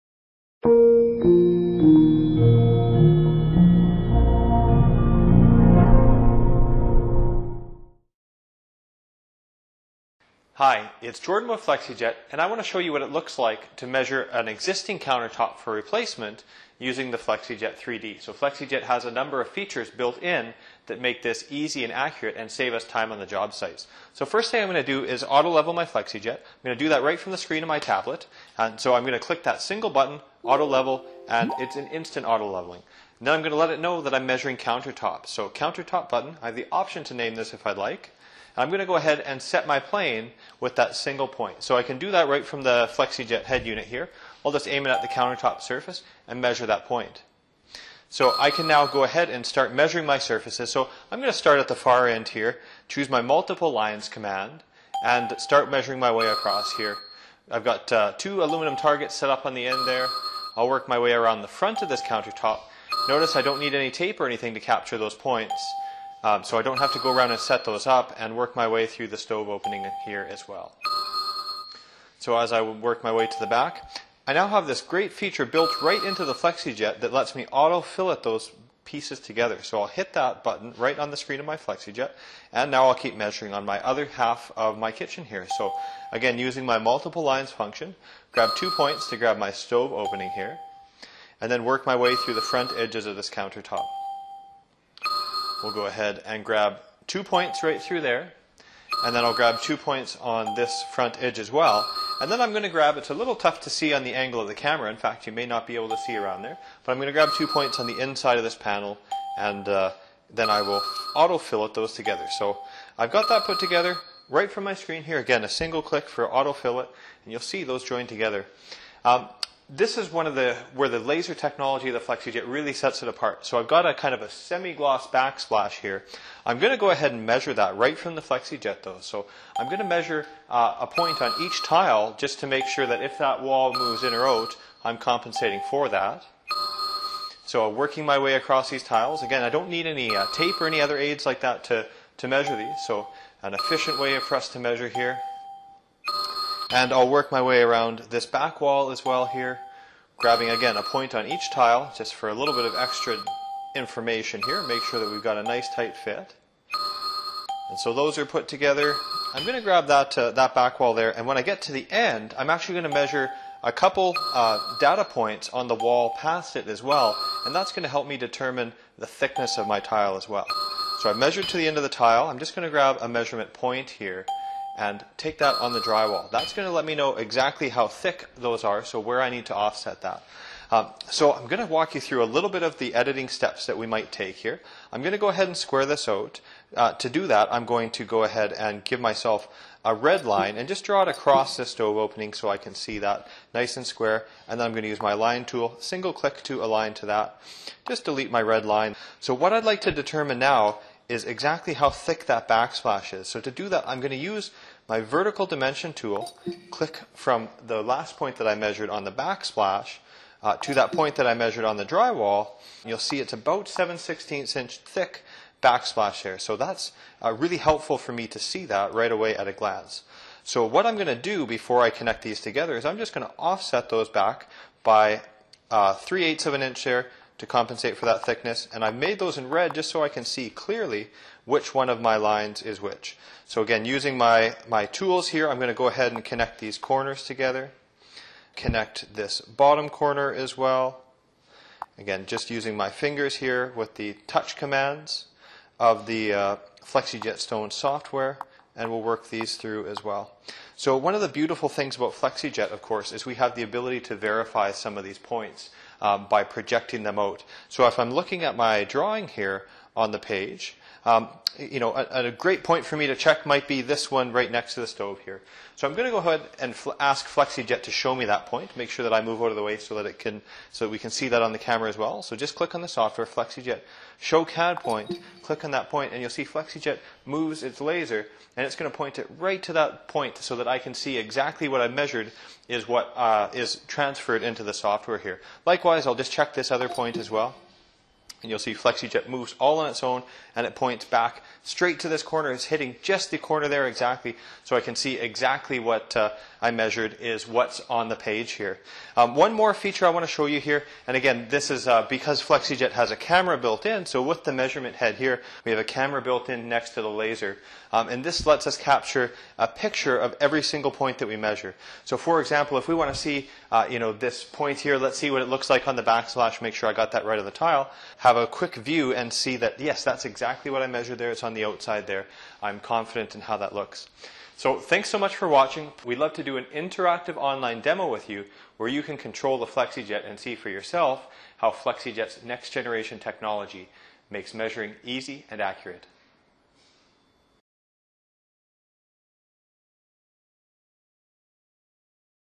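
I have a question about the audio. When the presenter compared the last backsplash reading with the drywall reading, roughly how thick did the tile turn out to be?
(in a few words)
7/16 inch.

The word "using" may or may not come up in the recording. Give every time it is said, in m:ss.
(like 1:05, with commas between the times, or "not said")
0:16, 1:26, 3:53, 4:02.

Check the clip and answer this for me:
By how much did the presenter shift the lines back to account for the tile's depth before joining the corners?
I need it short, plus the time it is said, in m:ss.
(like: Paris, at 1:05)
3/8 of an inch, at 3:45.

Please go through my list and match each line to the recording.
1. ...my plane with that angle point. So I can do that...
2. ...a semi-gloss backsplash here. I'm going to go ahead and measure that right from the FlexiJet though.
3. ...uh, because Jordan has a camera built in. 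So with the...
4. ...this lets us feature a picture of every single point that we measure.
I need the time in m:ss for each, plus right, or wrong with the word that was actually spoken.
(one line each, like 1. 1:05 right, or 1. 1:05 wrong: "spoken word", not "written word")
1. 0:39 wrong: "single", not "angle"
2. 2:04 right
3. 5:01 wrong: "FlexiJet", not "Jordan"
4. 5:08 wrong: "capture", not "feature".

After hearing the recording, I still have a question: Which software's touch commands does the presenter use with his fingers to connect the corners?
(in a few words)
FlexiJet Stone.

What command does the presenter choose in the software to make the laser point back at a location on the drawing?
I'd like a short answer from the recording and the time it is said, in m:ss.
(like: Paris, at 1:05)
show CAD point, at 4:34.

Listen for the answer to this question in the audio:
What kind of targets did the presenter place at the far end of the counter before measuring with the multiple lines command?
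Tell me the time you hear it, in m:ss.
0:58.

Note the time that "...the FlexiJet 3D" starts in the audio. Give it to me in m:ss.
0:17.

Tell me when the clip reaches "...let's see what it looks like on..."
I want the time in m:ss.
5:14.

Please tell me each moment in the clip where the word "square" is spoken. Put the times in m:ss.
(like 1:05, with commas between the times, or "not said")
3:05, 3:13.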